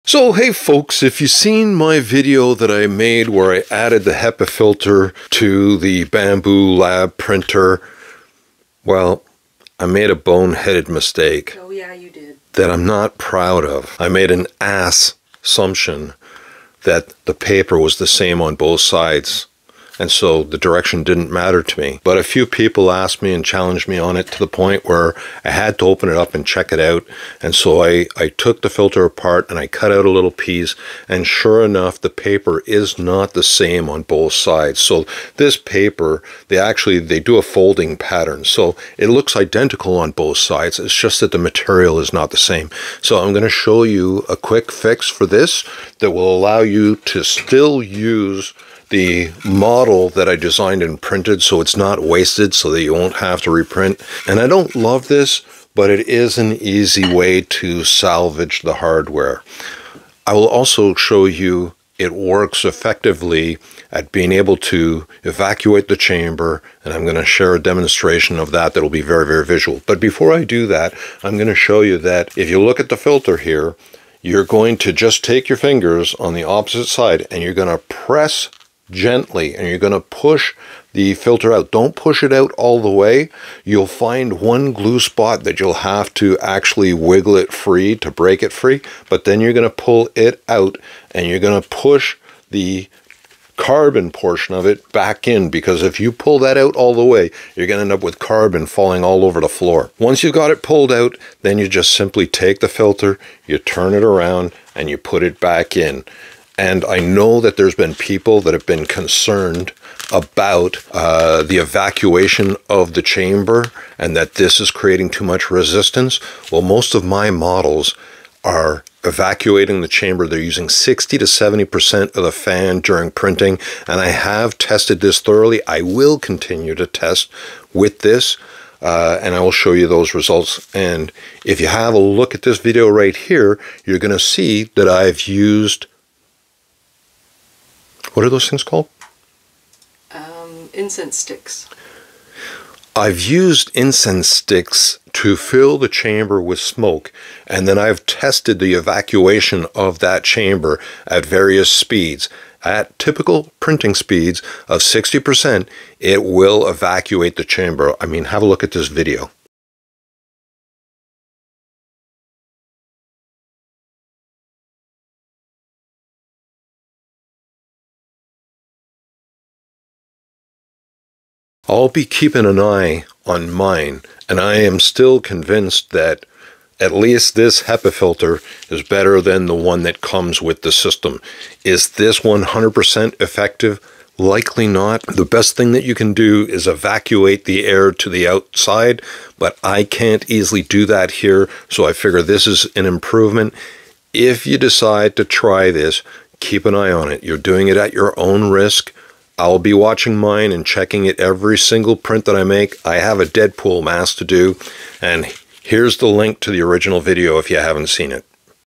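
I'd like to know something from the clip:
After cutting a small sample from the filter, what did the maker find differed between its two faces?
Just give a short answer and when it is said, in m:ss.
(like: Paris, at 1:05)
The material, at 0:41.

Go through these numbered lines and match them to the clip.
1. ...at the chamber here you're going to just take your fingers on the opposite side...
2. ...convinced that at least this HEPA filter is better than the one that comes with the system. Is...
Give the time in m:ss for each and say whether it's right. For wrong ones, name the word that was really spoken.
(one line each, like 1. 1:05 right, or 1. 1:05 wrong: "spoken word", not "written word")
1. 1:12 wrong: "filter", not "chamber"
2. 2:55 right.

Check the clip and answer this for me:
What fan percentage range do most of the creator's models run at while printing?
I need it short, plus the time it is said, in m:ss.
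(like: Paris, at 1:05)
60 to 70%, at 2:00.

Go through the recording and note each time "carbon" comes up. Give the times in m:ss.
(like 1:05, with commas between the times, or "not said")
1:33, 1:38.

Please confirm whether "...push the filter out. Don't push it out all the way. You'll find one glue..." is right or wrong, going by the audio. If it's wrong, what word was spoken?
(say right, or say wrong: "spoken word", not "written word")
right.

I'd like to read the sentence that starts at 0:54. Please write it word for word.
And I don't love this, but it is an easy way to salvage the hardware.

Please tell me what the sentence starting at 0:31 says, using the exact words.
And sure enough, the paper is not the same on both sides.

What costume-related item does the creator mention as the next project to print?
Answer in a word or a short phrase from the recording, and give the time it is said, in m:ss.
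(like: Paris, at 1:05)
A Deadpool mask, at 3:23.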